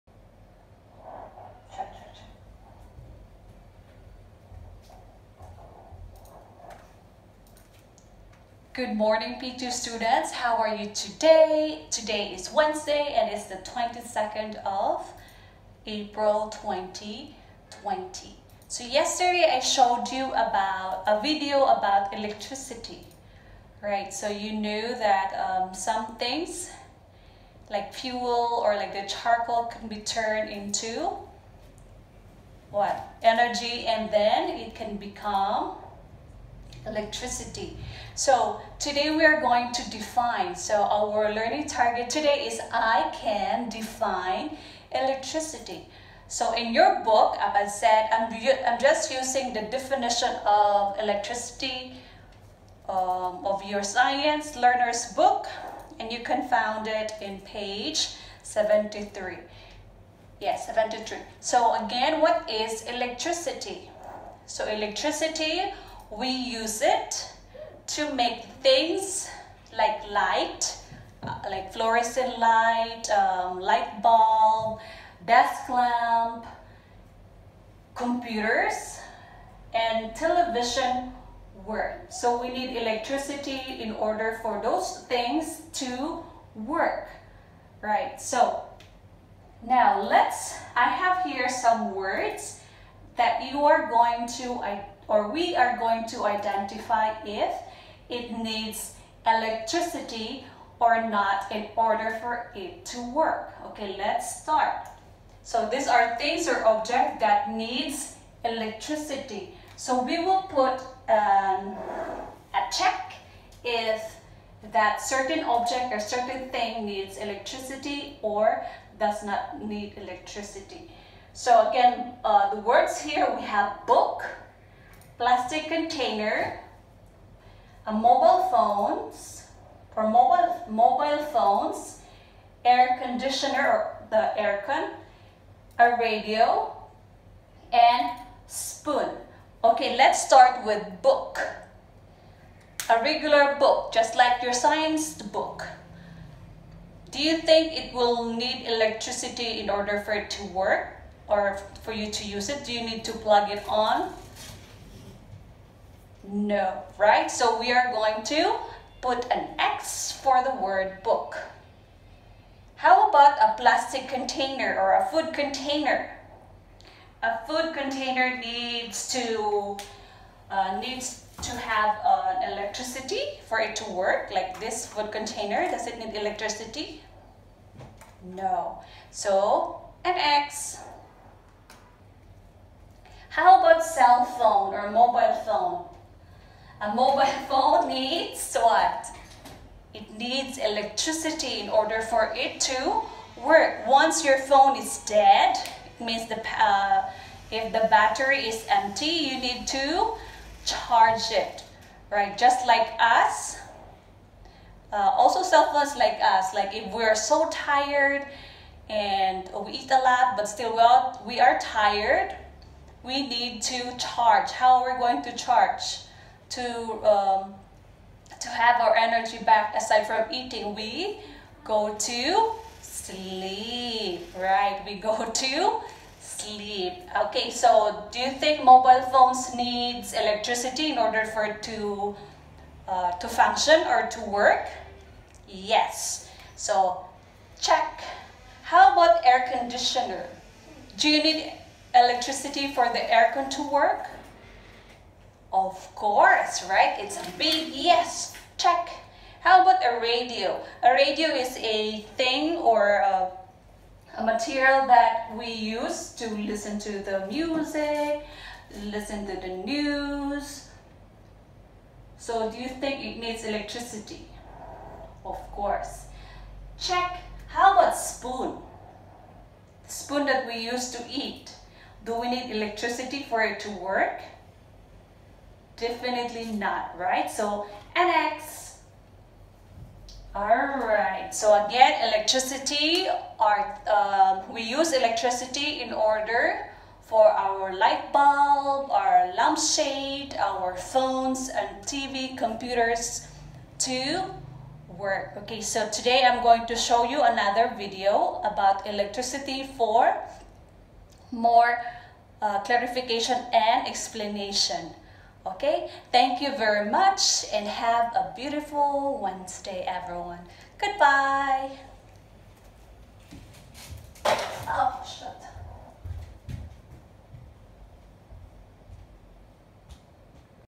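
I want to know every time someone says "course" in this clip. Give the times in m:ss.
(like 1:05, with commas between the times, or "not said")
4:05, 4:25.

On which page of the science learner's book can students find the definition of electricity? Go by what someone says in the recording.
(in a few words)
73.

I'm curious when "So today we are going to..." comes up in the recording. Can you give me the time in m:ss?
0:38.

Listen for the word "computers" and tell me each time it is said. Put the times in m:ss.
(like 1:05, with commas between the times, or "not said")
1:17, 4:52.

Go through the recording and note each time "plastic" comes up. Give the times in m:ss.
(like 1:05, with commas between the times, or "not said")
2:05, 2:43.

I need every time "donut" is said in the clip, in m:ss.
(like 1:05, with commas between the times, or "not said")
not said.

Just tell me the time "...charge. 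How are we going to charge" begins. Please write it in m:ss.
3:33.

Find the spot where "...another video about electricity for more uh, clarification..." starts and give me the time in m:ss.
4:57.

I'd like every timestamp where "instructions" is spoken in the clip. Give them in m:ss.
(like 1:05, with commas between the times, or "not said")
not said.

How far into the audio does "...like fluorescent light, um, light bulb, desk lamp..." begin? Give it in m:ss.
1:11.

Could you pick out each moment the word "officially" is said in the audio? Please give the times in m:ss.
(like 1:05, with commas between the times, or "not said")
not said.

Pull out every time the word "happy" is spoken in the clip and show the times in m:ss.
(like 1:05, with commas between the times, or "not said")
not said.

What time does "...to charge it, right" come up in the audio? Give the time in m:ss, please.
3:19.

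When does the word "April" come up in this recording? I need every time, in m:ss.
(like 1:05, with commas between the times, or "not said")
0:15.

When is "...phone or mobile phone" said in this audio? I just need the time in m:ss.
3:04.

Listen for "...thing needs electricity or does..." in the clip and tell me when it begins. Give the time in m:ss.
1:56.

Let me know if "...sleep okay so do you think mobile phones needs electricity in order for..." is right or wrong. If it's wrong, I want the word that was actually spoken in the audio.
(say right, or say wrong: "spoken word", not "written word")
right.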